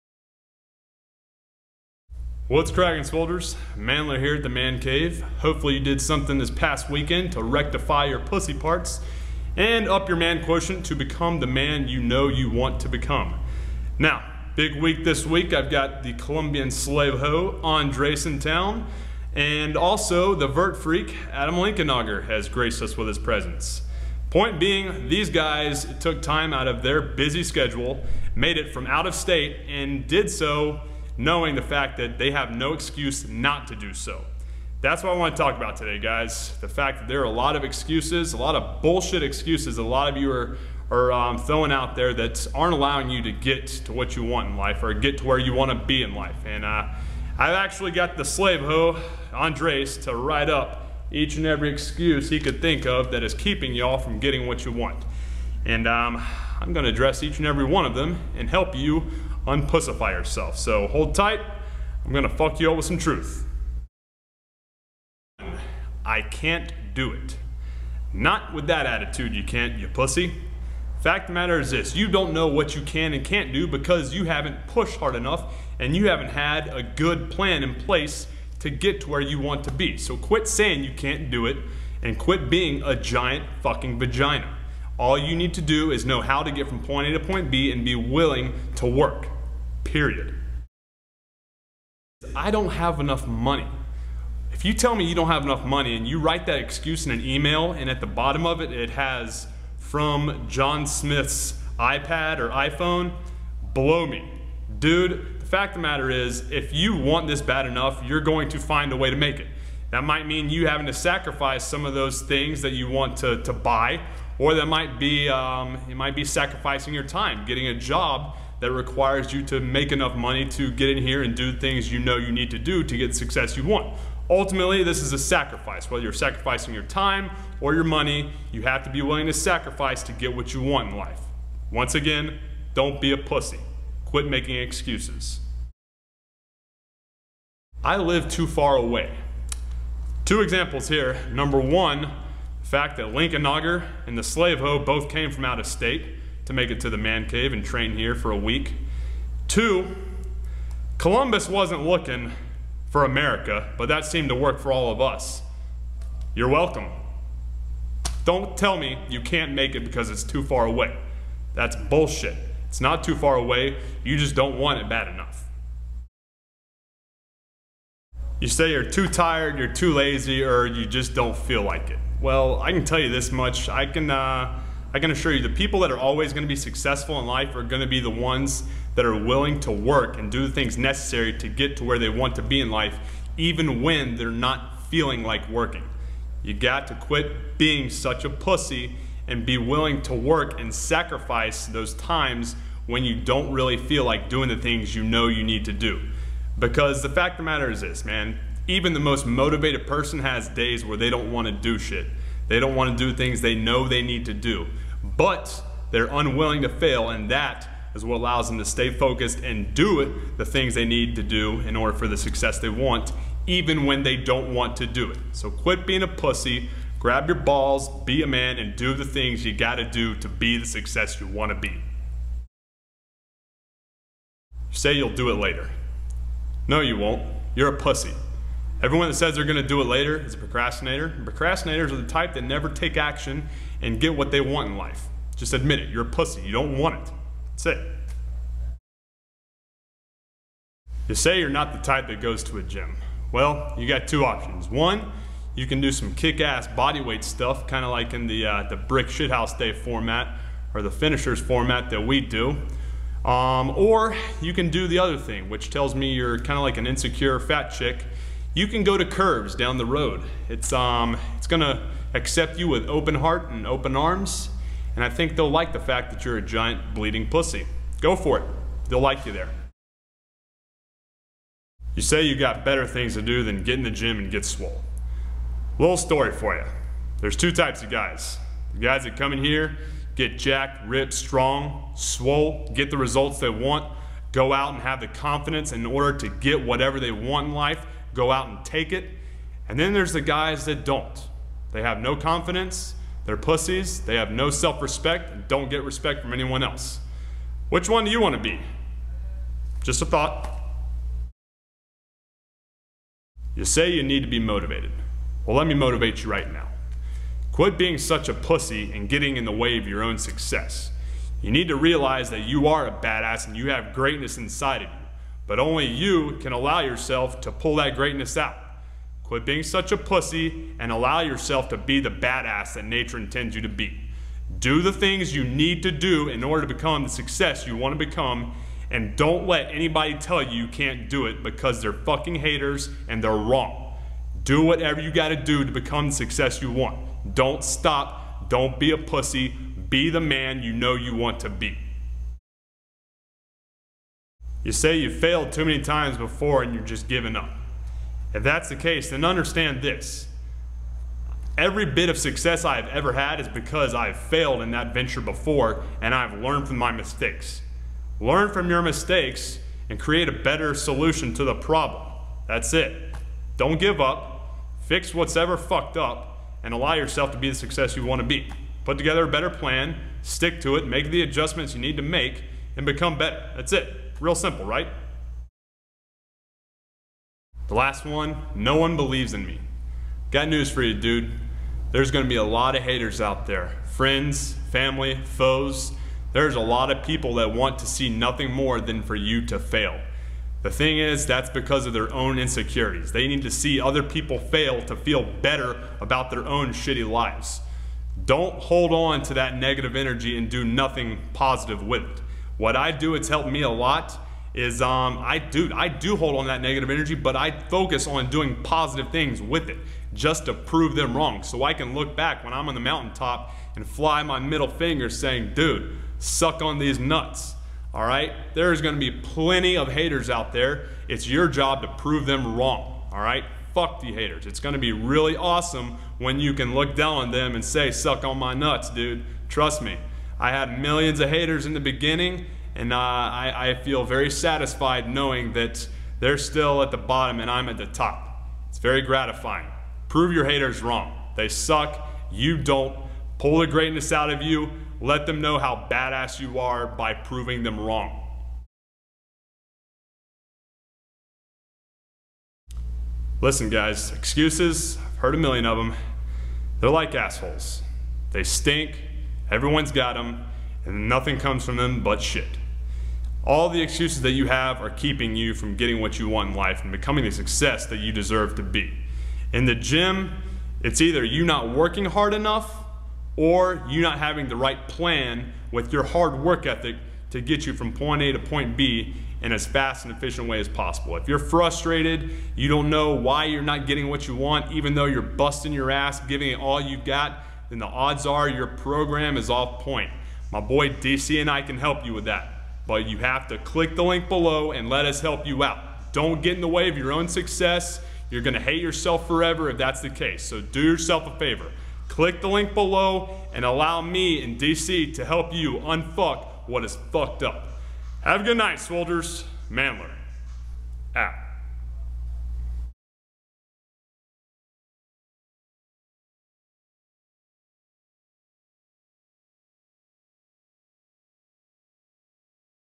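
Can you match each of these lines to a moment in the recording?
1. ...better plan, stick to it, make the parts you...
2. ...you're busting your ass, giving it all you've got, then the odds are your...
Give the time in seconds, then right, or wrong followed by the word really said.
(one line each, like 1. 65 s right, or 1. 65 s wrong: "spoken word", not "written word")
1. 369 s wrong: "adjustments", not "parts"
2. 485 s right.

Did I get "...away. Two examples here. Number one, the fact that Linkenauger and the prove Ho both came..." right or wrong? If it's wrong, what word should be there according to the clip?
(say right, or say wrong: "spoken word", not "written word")
wrong: "slave", not "prove".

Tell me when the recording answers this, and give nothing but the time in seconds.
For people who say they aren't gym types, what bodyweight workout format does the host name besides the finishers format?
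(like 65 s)
248 s.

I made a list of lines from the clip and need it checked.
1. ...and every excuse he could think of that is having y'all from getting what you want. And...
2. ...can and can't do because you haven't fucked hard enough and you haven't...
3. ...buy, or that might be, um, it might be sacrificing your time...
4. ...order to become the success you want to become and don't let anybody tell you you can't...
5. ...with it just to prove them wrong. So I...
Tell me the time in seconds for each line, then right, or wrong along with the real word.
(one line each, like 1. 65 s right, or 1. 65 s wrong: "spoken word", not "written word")
1. 51 s wrong: "keeping", not "having"
2. 72 s wrong: "pushed", not "fucked"
3. 113 s right
4. 326 s right
5. 409 s right.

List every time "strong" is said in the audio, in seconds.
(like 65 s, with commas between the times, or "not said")
281 s.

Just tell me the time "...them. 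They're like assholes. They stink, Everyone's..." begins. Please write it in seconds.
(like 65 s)
455 s.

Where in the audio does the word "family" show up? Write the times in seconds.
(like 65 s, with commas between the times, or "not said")
384 s.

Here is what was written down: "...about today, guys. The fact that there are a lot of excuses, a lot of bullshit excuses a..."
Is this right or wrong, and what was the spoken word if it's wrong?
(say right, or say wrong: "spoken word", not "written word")
right.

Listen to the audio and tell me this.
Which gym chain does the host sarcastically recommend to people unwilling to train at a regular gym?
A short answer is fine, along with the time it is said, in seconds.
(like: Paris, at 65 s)
Curves, at 259 s.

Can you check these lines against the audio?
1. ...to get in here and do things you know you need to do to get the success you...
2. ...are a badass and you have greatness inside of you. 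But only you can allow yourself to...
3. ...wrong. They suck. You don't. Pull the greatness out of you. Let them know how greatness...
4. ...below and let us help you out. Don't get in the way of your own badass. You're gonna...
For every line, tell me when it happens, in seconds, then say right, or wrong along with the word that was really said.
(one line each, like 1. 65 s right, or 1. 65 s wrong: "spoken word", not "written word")
1. 120 s right
2. 312 s right
3. 440 s wrong: "badass", not "greatness"
4. 494 s wrong: "success", not "badass".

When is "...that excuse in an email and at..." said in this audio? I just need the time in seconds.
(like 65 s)
96 s.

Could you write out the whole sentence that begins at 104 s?
Dude, the fact of the matter is, if you want this bad enough, you're going to find a way to make it.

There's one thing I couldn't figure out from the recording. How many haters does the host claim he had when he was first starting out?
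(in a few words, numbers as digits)
Millions.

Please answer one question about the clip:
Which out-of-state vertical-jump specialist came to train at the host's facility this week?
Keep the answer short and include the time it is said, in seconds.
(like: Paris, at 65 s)
Adam Linkenauger, at 21 s.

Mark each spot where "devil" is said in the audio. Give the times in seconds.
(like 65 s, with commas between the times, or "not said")
not said.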